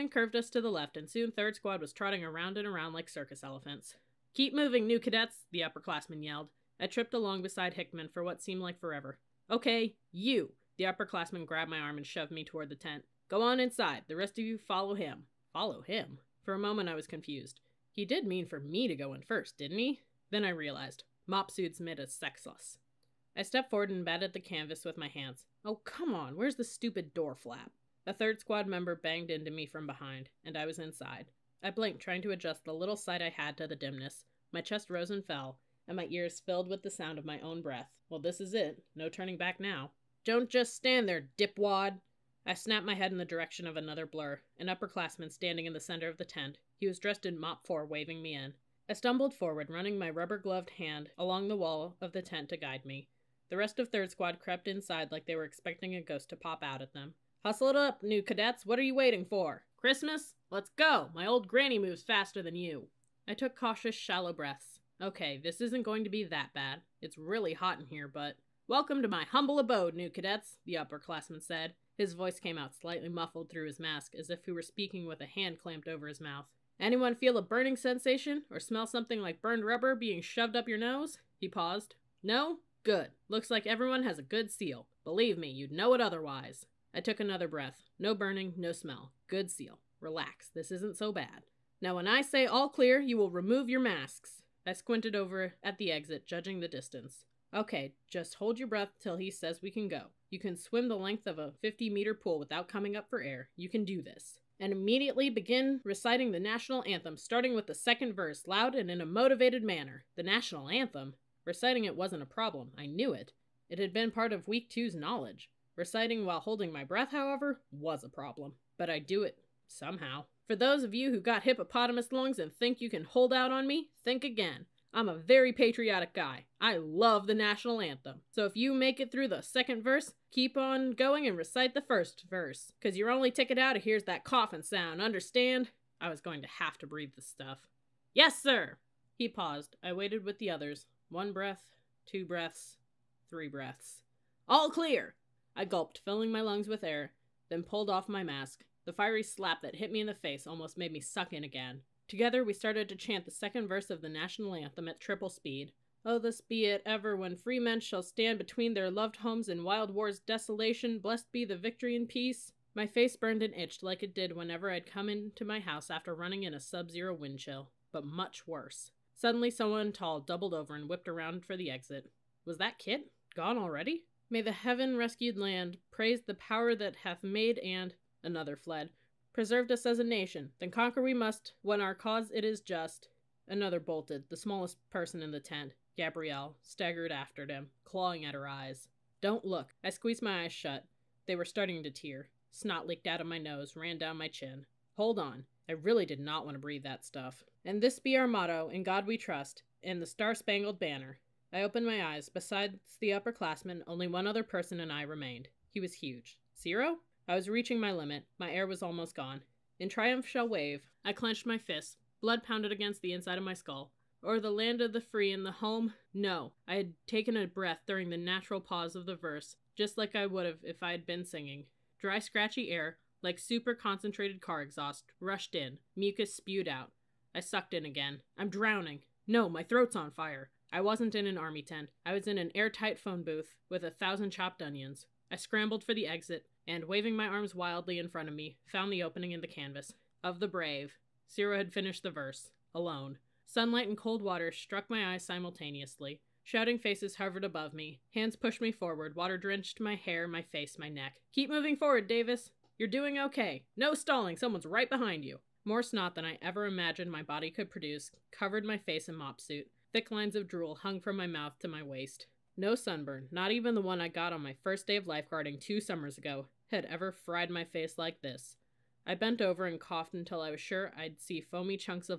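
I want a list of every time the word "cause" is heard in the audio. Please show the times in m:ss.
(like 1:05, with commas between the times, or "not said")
2:12, 3:01.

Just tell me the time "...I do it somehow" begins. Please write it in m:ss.
1:58.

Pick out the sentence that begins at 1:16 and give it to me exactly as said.
Anyone feel a burning sensation or smell something like burned rubber being shoved up your nose?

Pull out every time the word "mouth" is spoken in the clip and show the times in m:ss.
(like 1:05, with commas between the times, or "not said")
1:16, 4:21.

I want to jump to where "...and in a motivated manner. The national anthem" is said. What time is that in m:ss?
1:48.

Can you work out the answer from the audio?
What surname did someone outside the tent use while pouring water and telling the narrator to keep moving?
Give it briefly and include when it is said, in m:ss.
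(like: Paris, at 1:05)
Davis, at 4:12.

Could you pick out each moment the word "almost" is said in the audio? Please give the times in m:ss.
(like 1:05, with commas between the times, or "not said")
2:30, 3:28.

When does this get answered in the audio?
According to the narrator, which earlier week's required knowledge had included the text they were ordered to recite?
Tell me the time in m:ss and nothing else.
1:54.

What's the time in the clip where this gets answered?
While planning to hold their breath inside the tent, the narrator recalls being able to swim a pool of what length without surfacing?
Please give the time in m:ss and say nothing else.
1:41.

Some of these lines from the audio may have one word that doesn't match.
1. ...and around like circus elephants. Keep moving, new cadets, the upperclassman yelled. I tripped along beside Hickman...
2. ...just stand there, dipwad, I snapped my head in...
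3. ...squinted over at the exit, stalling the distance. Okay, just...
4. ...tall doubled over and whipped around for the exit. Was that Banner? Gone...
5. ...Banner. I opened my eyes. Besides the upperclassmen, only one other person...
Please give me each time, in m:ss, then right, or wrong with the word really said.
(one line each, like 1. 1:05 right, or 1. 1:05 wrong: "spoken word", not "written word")
1. 0:02 right
2. 0:40 right
3. 1:34 wrong: "judging", not "stalling"
4. 2:49 wrong: "Kit", not "Banner"
5. 3:20 right.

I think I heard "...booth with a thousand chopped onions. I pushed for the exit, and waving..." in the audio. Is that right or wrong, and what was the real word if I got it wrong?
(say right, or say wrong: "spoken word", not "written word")
wrong: "scrambled", not "pushed".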